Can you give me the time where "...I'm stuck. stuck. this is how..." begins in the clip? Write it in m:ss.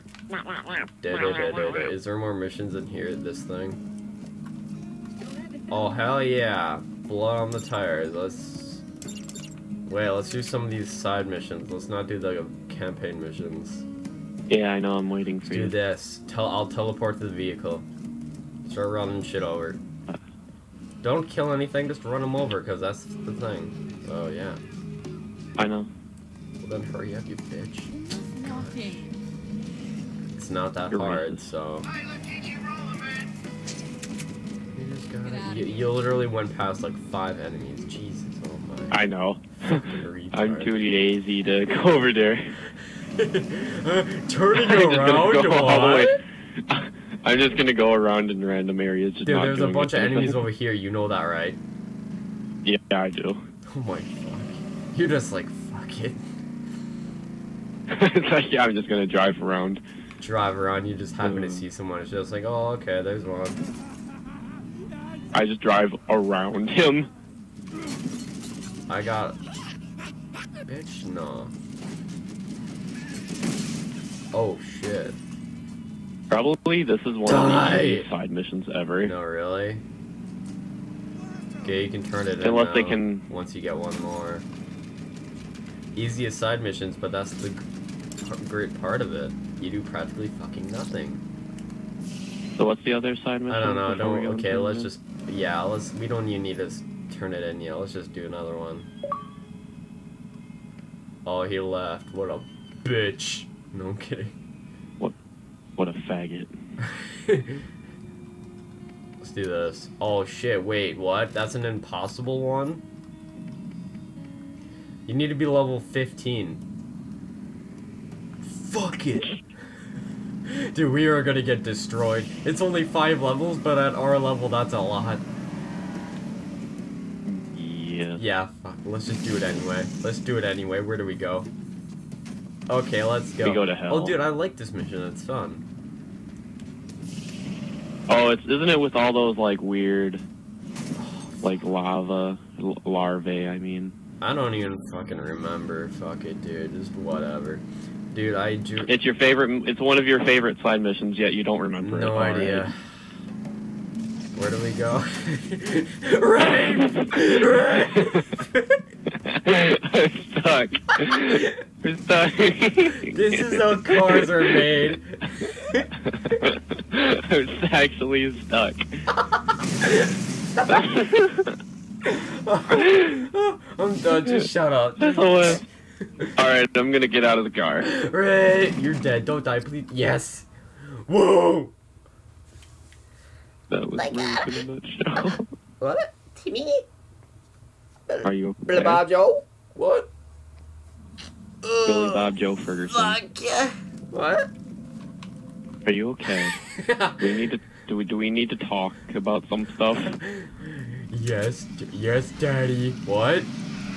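2:39.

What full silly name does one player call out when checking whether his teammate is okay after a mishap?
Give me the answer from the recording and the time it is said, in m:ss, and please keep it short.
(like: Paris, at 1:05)
Billy Bob Joe Ferguson, at 3:11.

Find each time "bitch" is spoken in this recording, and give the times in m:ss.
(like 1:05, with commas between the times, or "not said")
0:27, 1:10, 1:42.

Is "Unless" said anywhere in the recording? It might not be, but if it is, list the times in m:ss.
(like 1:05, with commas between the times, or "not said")
1:22.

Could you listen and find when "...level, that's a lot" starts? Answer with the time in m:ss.
2:04.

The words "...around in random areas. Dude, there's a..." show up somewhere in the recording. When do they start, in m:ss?
0:47.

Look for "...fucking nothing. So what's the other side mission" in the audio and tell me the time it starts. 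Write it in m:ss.
1:30.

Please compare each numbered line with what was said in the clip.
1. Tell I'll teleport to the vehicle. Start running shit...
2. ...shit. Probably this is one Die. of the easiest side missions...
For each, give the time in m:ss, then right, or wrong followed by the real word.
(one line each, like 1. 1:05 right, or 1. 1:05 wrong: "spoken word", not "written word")
1. 0:16 right
2. 1:14 right.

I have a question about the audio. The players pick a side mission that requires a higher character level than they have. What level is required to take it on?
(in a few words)
15.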